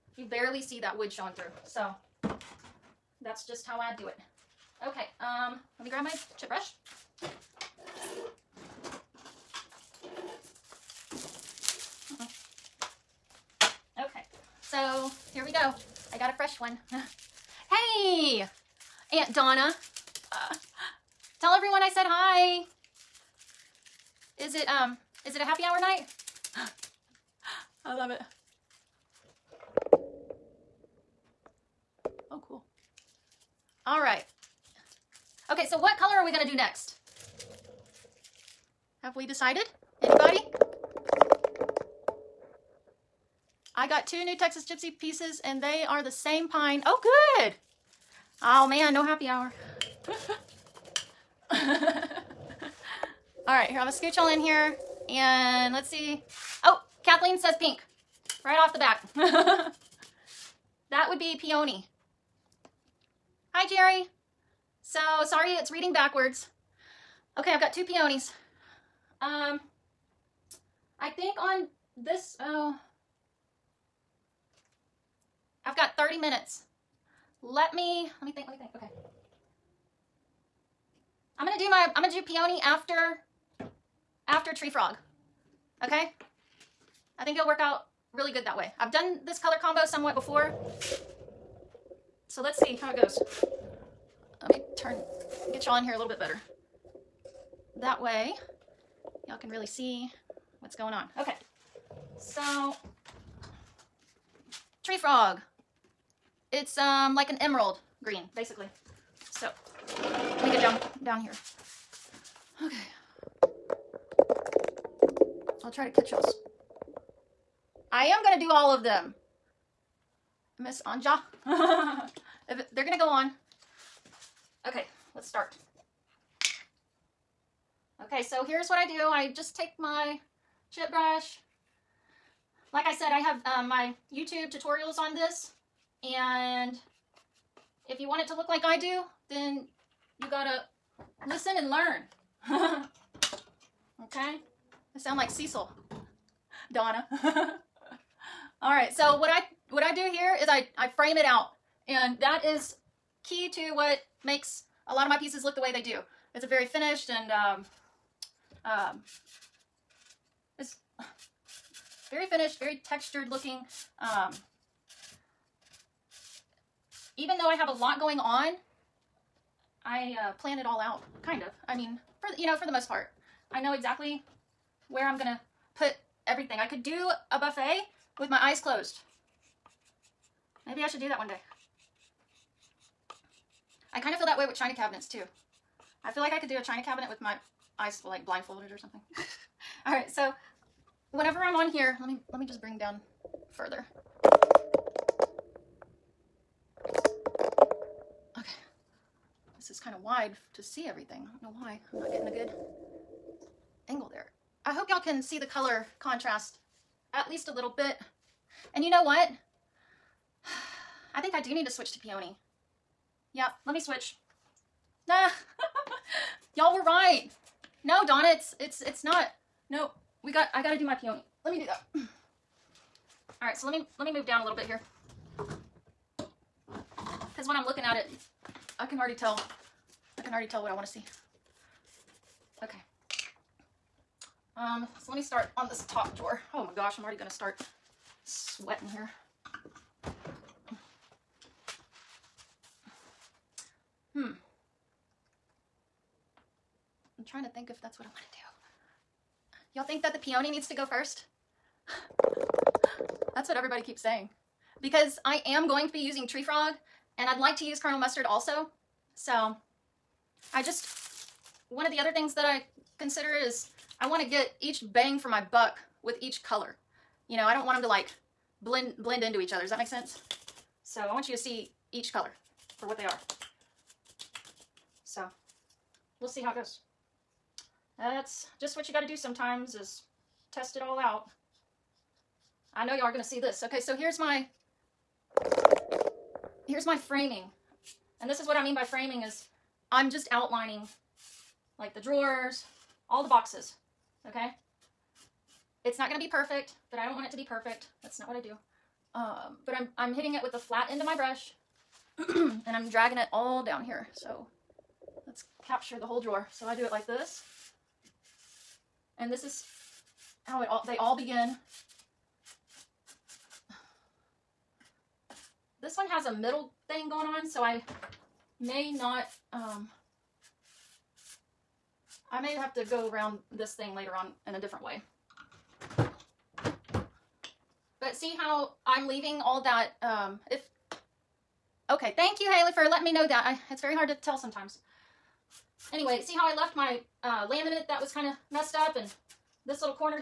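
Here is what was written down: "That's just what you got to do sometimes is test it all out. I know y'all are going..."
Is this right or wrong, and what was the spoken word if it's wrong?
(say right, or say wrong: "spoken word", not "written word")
right.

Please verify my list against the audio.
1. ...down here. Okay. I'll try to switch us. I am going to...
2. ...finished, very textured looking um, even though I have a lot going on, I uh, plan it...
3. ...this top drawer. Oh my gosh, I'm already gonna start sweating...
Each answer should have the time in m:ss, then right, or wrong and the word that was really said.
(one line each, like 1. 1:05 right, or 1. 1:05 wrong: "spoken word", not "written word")
1. 1:51 wrong: "catch", not "switch"
2. 2:42 right
3. 3:55 right.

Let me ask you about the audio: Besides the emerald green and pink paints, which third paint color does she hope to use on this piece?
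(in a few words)
Colonel Mustard.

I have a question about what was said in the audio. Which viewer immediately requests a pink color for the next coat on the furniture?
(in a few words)
Kathleen.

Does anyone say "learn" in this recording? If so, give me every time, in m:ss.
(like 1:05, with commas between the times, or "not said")
2:21.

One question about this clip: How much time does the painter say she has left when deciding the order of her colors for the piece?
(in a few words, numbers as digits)
30 minutes.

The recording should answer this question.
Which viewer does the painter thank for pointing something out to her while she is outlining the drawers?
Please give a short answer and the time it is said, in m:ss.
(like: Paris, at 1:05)
Haley, at 5:32.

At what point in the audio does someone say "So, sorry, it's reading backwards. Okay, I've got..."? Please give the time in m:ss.
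1:04.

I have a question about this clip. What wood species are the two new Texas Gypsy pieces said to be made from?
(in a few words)
Pine.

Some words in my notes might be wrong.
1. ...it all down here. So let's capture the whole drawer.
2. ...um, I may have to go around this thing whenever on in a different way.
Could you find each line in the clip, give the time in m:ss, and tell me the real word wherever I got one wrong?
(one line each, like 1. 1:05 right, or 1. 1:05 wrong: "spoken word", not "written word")
1. 5:03 right
2. 5:19 wrong: "later", not "whenever".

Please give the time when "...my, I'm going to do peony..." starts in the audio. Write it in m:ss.
1:21.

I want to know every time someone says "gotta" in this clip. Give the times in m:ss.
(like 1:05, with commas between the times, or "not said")
2:20, 3:40.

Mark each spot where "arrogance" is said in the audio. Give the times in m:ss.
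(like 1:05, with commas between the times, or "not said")
not said.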